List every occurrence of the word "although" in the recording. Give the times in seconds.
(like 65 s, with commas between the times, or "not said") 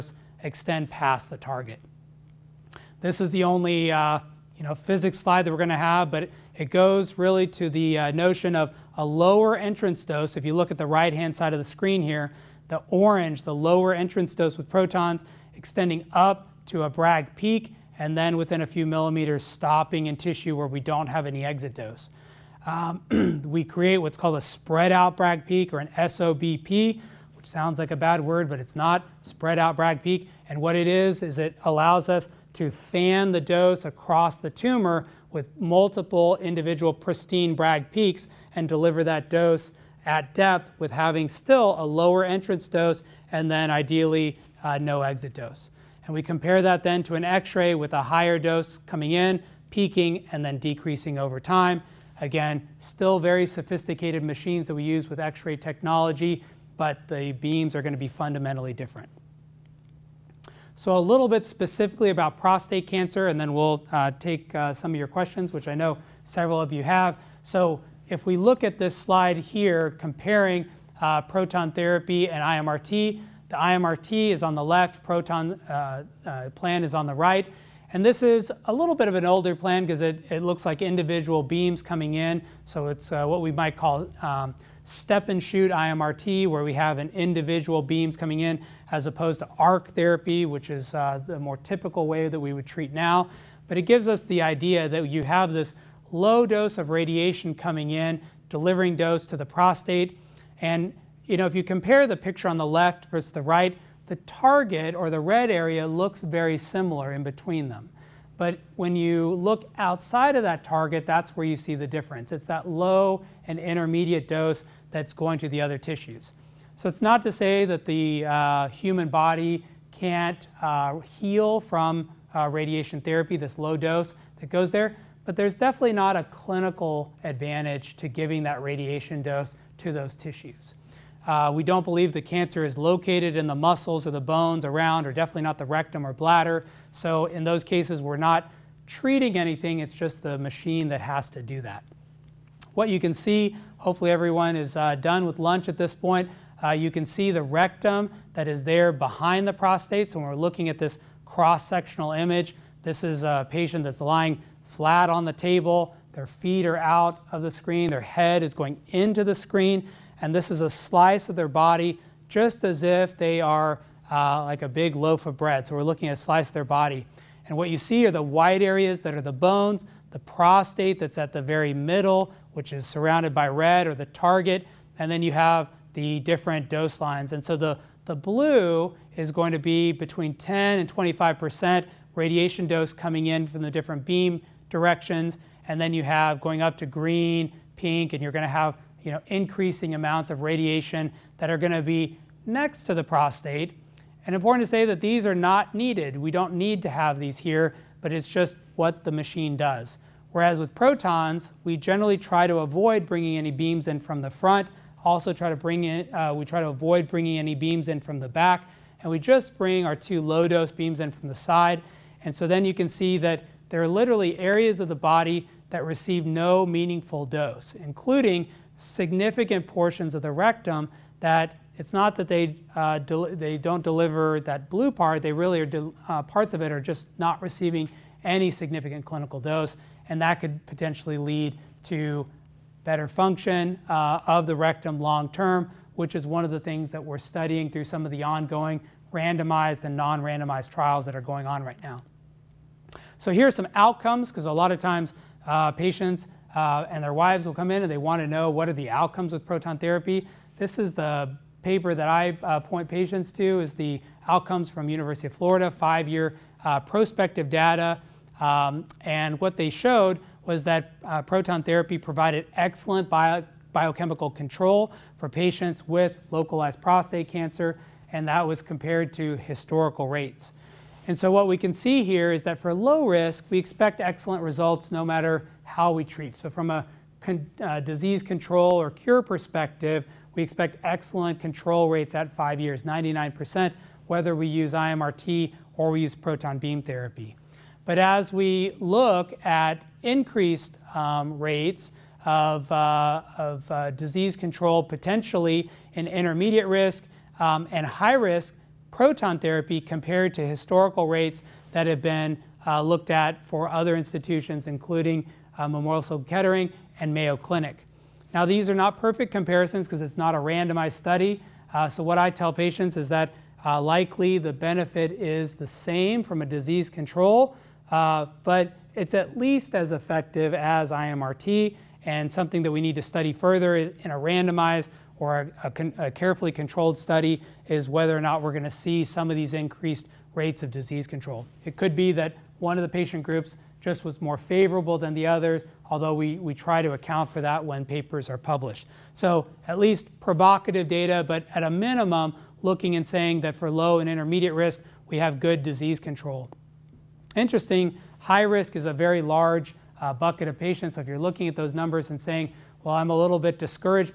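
335 s.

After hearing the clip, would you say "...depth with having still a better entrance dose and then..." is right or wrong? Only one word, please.
wrong.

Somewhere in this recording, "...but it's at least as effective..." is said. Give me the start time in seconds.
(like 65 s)
318 s.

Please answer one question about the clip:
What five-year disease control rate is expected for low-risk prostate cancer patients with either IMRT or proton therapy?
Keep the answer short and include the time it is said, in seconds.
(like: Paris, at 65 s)
99%, at 282 s.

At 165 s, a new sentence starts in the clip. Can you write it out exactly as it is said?
So we're looking at a slice of their body.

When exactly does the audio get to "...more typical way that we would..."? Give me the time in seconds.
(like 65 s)
91 s.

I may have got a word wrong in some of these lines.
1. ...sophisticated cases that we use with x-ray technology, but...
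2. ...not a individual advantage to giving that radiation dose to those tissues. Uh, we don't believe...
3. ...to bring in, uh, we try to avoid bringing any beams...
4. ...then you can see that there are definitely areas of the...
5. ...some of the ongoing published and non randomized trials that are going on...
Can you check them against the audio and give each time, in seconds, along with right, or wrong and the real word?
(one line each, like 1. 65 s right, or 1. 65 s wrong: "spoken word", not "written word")
1. 53 s wrong: "machines", not "cases"
2. 125 s wrong: "clinical", not "individual"
3. 205 s right
4. 212 s wrong: "literally", not "definitely"
5. 237 s wrong: "randomized", not "published".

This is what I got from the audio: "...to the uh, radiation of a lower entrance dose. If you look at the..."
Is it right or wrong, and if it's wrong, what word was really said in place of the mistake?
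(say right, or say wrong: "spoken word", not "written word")
wrong: "notion", not "radiation".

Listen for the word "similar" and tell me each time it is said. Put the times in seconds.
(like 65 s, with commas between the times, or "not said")
106 s.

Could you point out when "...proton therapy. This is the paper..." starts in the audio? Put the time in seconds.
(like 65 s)
249 s.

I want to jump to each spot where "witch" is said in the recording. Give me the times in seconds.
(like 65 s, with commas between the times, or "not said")
not said.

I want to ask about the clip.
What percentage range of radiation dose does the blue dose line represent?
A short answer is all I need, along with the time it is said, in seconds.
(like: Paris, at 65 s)
10 to 25%, at 179 s.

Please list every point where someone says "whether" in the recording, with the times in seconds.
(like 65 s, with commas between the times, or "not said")
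284 s, 327 s.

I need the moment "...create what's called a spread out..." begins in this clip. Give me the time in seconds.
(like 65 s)
23 s.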